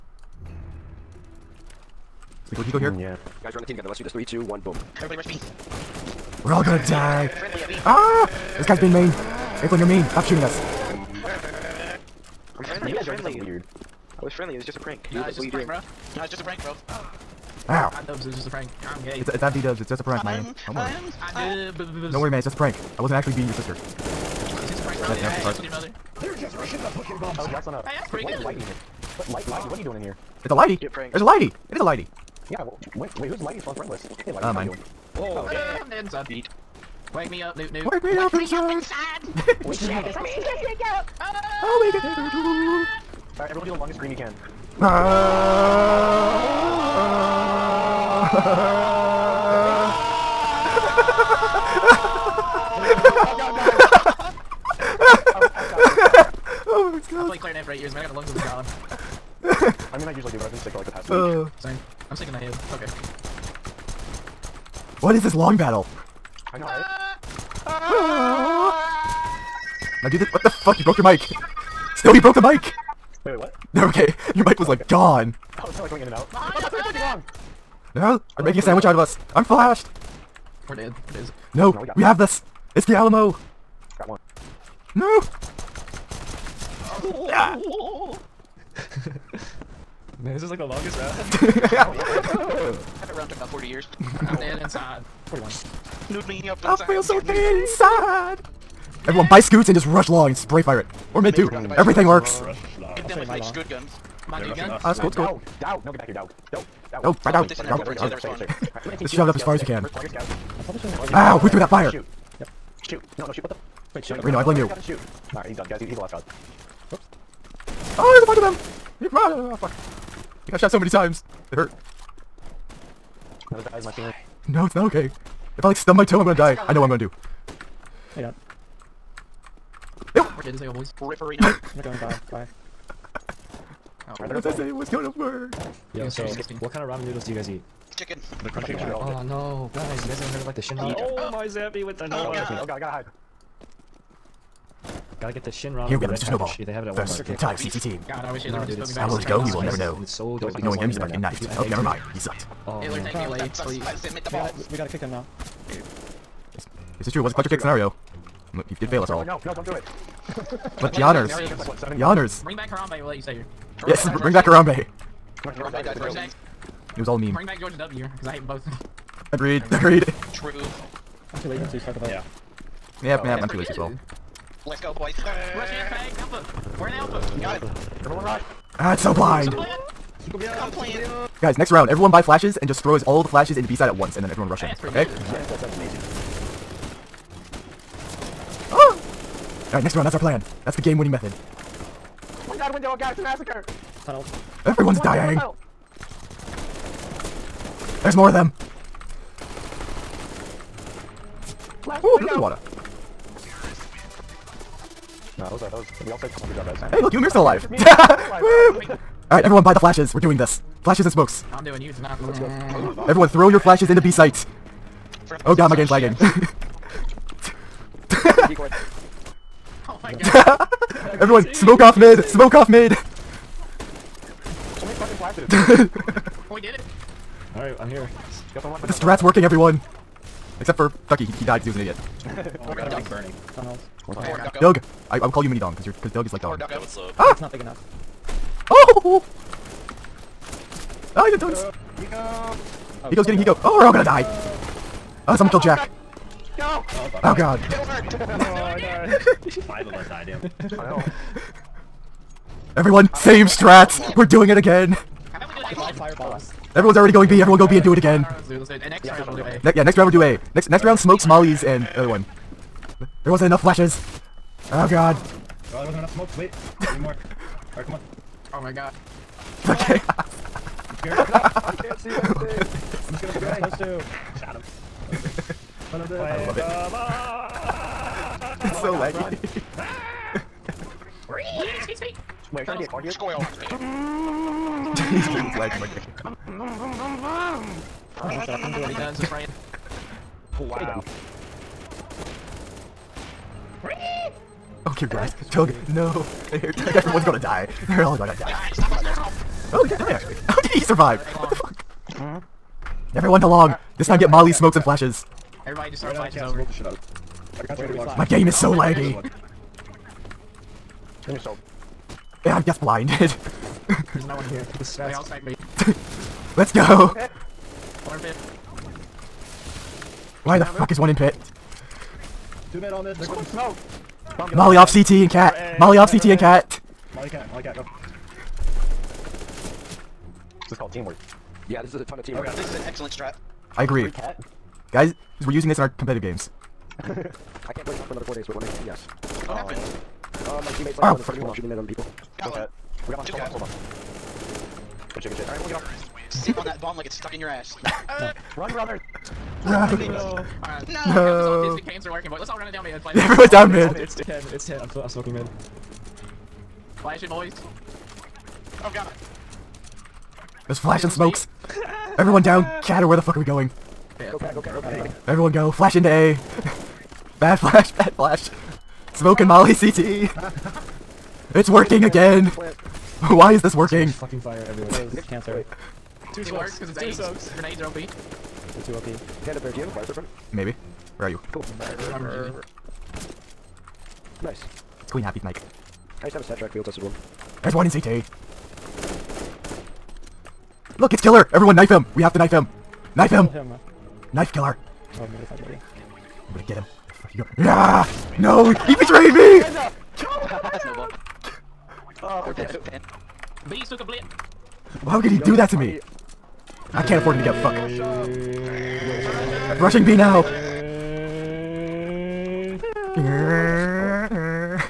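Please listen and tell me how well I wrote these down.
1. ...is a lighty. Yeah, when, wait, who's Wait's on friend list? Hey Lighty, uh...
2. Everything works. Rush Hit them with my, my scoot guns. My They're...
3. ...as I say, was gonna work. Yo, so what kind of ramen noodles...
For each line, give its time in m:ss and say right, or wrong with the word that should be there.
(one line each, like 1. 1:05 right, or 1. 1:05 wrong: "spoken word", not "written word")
1. 0:31 wrong: "Lighty", not "Wait"
2. 1:41 right
3. 2:14 right.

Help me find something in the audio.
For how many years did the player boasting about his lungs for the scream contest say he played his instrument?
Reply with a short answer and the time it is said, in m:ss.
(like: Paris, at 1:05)
8, at 0:57.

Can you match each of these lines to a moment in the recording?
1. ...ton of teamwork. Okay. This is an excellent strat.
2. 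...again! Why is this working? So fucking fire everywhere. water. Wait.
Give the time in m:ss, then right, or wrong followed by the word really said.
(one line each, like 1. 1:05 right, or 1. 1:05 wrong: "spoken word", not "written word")
1. 5:32 right
2. 6:12 wrong: "cancer", not "water".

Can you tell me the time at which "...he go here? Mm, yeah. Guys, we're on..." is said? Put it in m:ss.
0:02.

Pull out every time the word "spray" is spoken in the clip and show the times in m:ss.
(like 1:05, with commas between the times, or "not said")
1:40, 4:33.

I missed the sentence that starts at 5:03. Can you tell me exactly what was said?
This time get Molly, smokes, and flashes.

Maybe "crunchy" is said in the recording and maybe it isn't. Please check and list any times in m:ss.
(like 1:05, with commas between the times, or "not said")
2:18.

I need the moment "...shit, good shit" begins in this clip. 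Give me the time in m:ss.
5:45.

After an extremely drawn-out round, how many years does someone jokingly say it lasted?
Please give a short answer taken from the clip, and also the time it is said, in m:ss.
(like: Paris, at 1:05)
40, at 1:33.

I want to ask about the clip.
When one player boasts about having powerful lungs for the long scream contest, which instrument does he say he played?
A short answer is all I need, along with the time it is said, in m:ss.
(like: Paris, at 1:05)
clarinet, at 0:57.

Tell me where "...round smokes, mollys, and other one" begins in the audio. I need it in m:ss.
4:20.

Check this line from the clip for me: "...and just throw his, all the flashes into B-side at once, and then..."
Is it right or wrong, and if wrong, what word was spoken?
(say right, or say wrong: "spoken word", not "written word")
right.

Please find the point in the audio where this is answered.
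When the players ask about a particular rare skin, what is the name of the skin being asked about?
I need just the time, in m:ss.
6:19.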